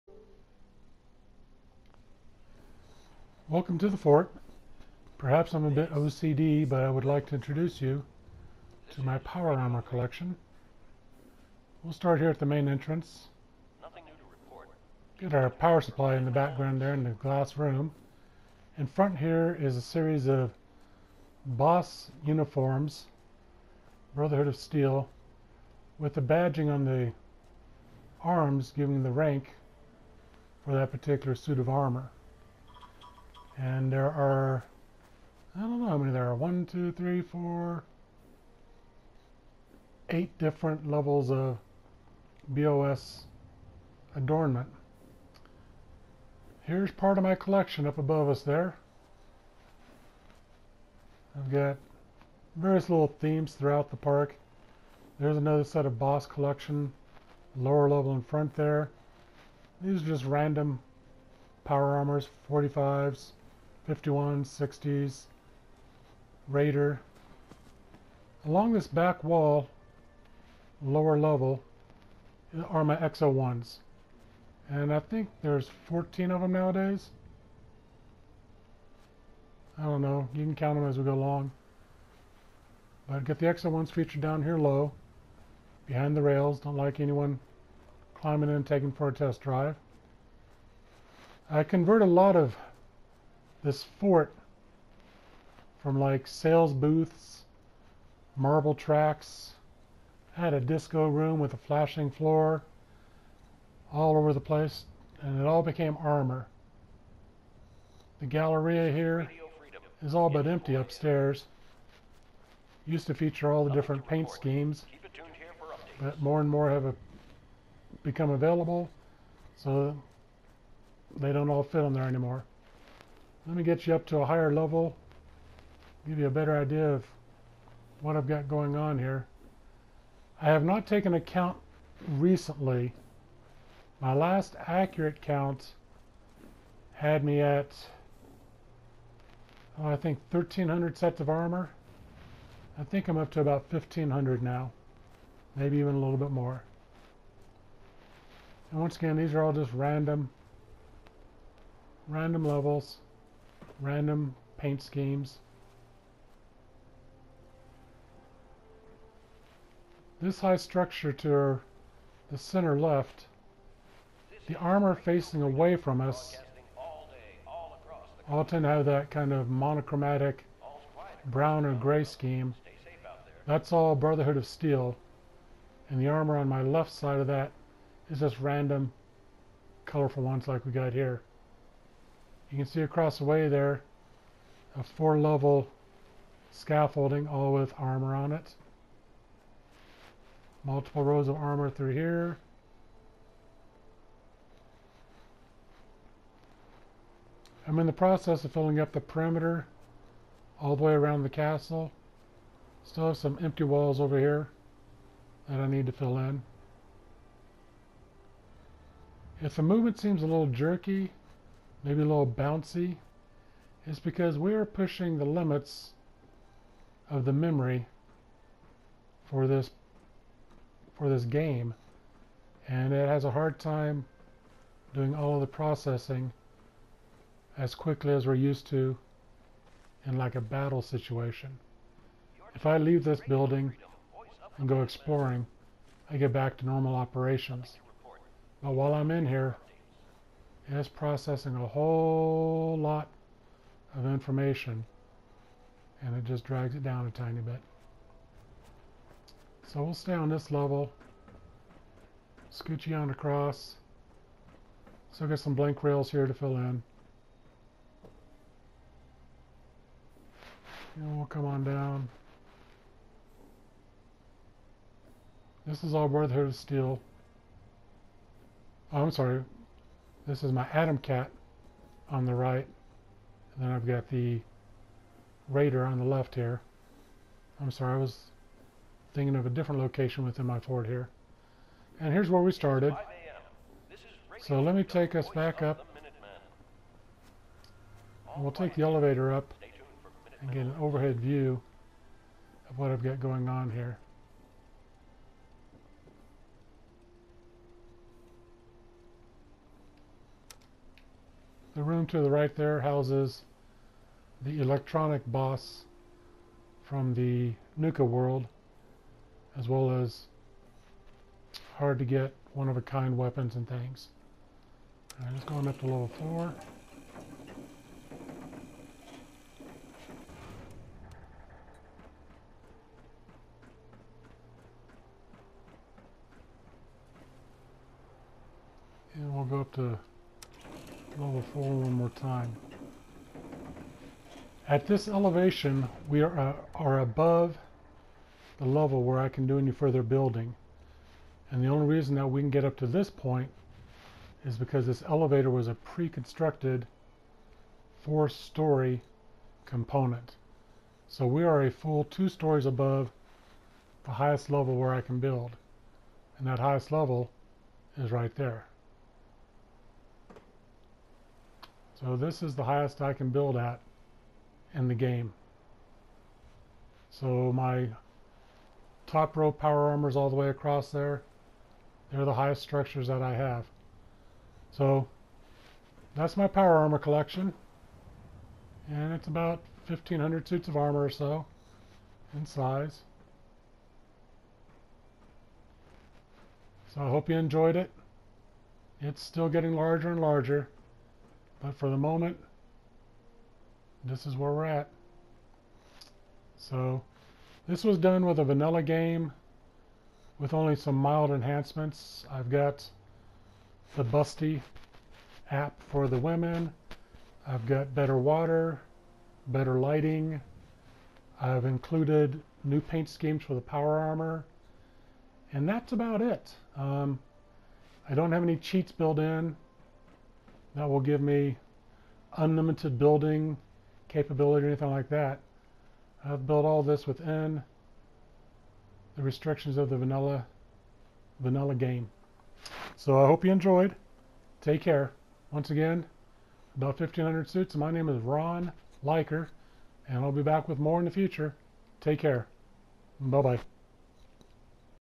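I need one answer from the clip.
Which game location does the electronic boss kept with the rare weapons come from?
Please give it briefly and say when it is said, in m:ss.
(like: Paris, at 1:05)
Nuka World, at 5:07.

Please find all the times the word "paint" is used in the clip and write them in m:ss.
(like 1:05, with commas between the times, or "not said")
1:54, 2:34, 6:52.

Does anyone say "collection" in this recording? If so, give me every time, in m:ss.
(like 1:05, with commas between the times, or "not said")
0:09, 0:47, 0:56, 6:16.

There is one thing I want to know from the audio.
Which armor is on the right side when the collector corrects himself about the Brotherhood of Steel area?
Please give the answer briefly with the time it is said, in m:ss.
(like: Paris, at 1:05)
Atom Cat, at 4:30.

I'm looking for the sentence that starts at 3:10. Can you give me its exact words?
Multiple rows of armor through here.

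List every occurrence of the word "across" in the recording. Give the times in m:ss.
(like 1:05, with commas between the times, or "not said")
3:02, 4:13, 6:10.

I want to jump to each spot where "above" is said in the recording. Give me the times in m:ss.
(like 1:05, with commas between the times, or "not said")
0:47, 5:36, 5:52.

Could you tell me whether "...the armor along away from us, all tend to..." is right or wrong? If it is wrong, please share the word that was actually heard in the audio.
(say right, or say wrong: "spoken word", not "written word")
wrong: "facing", not "along".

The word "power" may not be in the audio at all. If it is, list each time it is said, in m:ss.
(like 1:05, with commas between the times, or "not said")
0:09, 0:15, 1:01, 6:09, 6:16, 6:53.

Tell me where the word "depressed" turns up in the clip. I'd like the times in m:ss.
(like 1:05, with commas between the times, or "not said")
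not said.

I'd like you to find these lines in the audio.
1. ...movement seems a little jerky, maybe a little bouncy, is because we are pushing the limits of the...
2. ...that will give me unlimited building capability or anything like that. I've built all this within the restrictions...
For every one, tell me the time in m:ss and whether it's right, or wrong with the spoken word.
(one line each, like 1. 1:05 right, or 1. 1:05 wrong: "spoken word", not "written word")
1. 3:29 right
2. 7:00 right.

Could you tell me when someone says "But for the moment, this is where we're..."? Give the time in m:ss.
6:31.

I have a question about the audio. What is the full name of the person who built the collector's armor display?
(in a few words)
Ron Leiker.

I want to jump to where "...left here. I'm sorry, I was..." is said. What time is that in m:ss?
4:36.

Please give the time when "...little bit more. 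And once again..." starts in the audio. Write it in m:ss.
2:25.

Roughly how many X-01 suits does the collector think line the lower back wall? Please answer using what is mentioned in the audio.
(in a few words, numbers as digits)
14.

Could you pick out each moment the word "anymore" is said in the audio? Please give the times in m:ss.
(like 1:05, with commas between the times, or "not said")
2:02.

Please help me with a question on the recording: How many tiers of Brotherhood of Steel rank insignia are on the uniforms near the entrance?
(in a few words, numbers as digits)
8.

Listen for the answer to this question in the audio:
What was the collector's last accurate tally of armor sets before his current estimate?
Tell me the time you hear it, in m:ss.
2:20.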